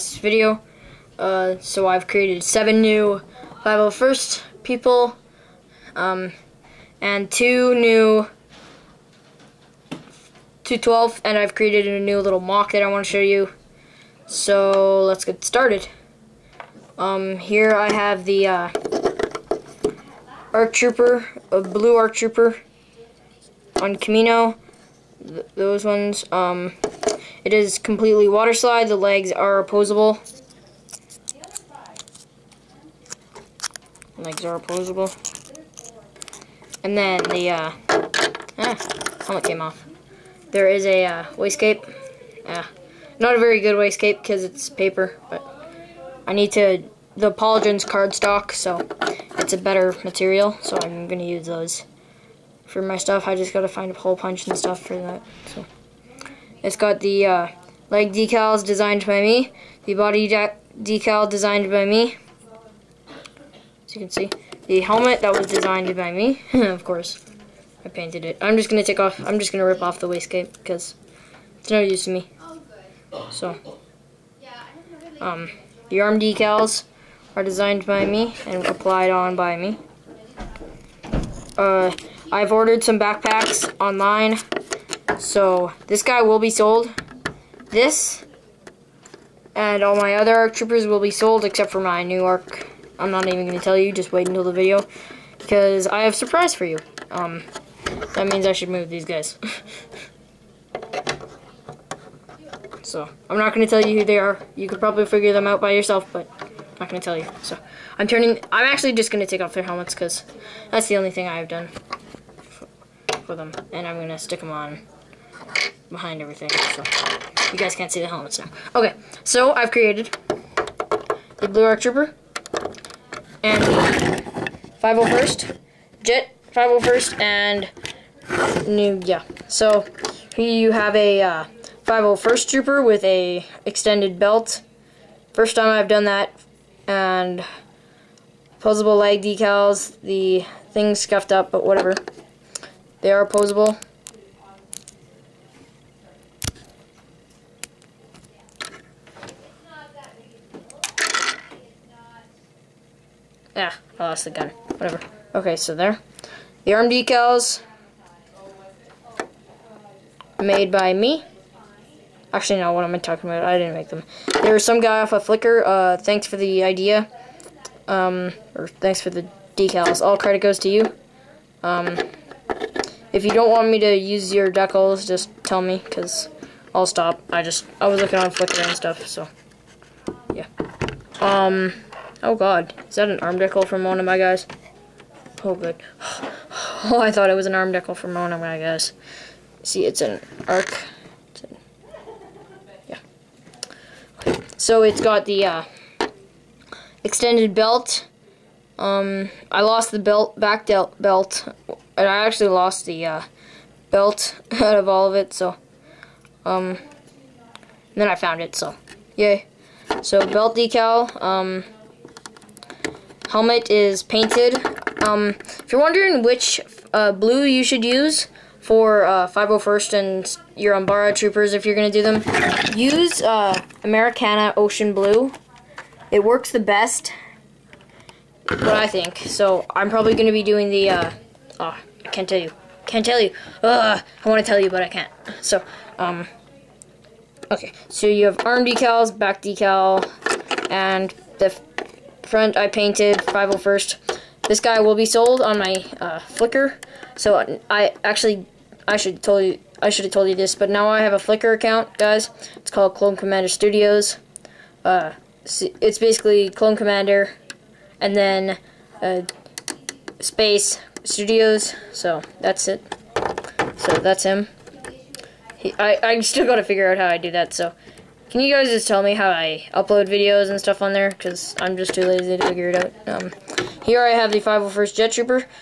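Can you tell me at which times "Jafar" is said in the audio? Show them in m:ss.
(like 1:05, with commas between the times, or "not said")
not said.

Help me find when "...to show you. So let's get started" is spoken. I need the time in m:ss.
0:13.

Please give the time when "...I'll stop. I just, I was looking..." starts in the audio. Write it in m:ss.
2:56.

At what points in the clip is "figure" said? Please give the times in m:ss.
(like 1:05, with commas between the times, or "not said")
1:45, 4:26, 4:32.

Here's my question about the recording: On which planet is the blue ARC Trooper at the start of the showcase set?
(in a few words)
Kamino.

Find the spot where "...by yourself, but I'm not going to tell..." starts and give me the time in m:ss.
1:45.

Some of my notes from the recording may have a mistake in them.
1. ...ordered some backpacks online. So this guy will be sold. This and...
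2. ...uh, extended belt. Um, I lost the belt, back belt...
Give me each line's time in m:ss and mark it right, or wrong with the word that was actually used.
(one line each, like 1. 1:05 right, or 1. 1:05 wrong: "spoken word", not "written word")
1. 1:22 right
2. 3:15 right.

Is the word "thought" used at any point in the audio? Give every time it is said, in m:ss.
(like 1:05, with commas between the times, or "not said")
3:07.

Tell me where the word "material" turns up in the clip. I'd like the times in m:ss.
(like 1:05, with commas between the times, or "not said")
0:50.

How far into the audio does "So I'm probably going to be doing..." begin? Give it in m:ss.
3:49.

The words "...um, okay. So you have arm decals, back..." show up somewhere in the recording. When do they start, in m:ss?
3:55.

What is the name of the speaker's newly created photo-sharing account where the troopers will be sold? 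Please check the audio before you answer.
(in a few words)
Clone Commander Studios.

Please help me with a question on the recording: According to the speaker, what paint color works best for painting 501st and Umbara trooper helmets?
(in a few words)
Americana Ocean Blue.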